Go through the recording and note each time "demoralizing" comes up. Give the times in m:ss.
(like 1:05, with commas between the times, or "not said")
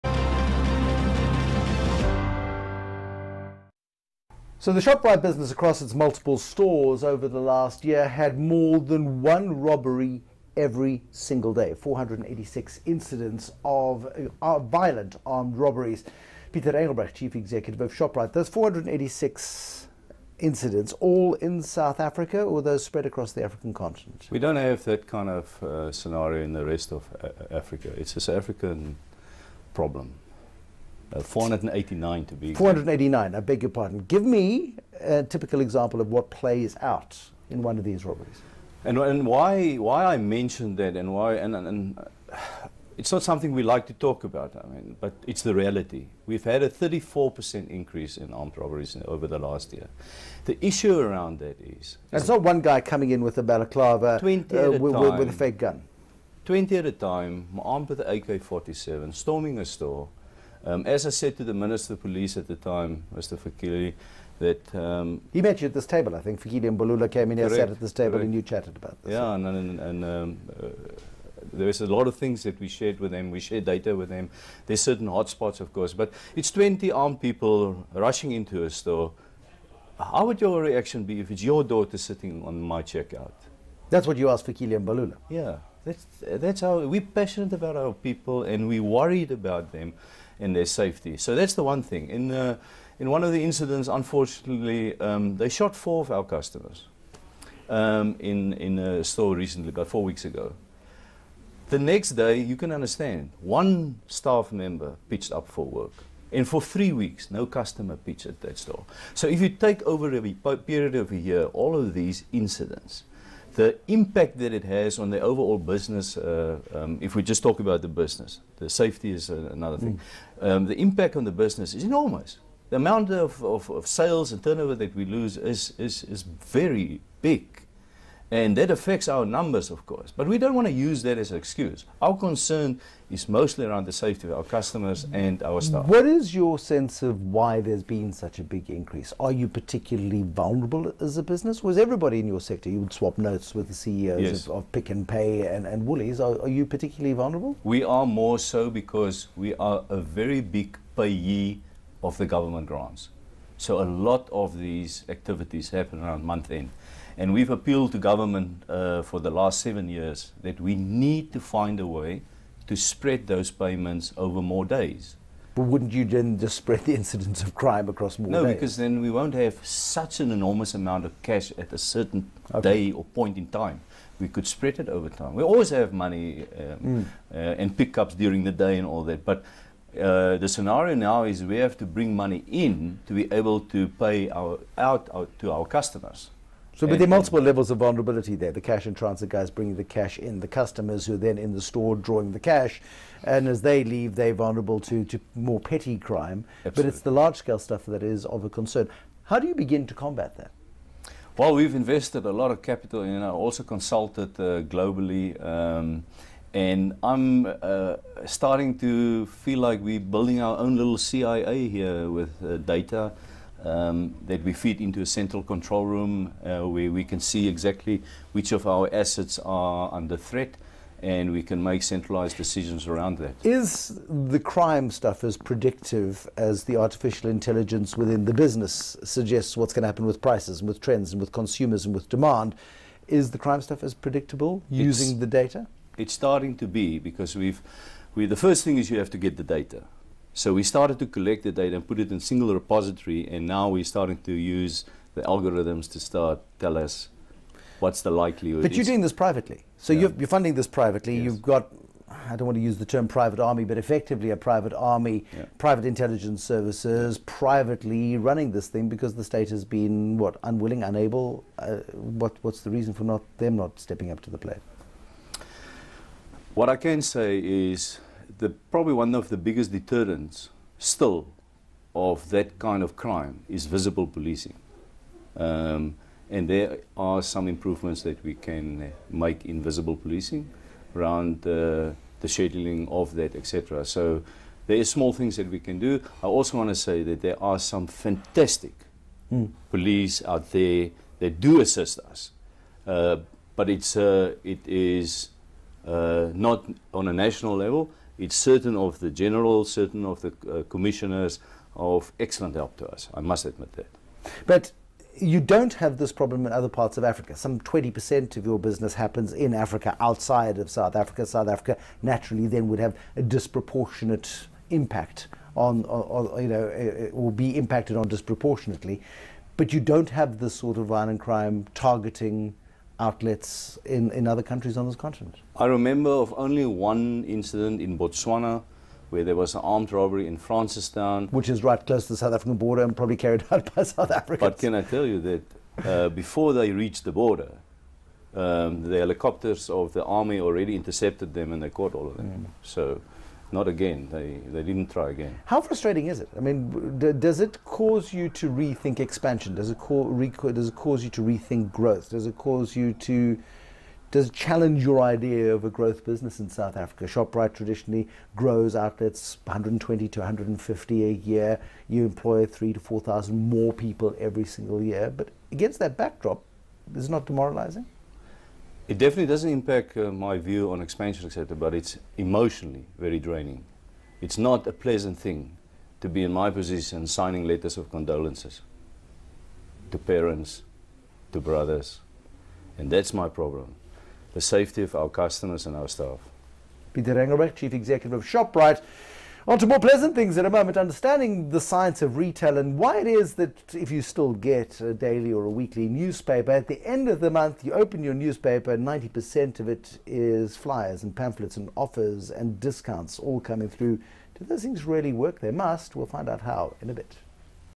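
6:07.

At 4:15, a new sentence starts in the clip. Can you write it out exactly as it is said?
private intelligence services, privately running this thing because the state has been, what, unwilling, unable?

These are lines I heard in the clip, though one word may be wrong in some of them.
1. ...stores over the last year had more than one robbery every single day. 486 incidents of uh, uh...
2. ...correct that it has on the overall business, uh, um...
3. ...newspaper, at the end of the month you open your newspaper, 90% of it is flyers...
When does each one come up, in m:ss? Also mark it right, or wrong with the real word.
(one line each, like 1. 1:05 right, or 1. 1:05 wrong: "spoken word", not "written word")
1. 0:06 right
2. 1:53 wrong: "impact", not "correct"
3. 6:35 right.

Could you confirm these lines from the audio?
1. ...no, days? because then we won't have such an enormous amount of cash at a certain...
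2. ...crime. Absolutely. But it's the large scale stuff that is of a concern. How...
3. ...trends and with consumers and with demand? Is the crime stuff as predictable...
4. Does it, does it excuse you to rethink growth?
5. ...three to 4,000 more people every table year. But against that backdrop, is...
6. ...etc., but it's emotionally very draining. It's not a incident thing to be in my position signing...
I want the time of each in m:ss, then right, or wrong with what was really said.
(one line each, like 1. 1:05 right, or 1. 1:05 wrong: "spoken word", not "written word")
1. 2:48 right
2. 3:15 right
3. 3:50 right
4. 5:49 wrong: "cause", not "excuse"
5. 6:02 wrong: "single", not "table"
6. 6:11 wrong: "pleasant", not "incident".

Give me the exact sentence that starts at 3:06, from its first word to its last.
So, but there are multiple levels of vulnerability there.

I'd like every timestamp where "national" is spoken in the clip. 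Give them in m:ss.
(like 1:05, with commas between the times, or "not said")
4:57.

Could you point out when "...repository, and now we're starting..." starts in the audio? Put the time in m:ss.
4:02.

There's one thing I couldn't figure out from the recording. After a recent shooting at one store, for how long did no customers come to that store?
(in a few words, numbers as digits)
three weeks.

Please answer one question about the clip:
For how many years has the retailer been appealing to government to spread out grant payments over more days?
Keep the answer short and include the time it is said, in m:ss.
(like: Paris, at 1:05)
seven years, at 2:39.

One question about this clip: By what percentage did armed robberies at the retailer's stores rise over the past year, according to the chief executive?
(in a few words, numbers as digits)
34%.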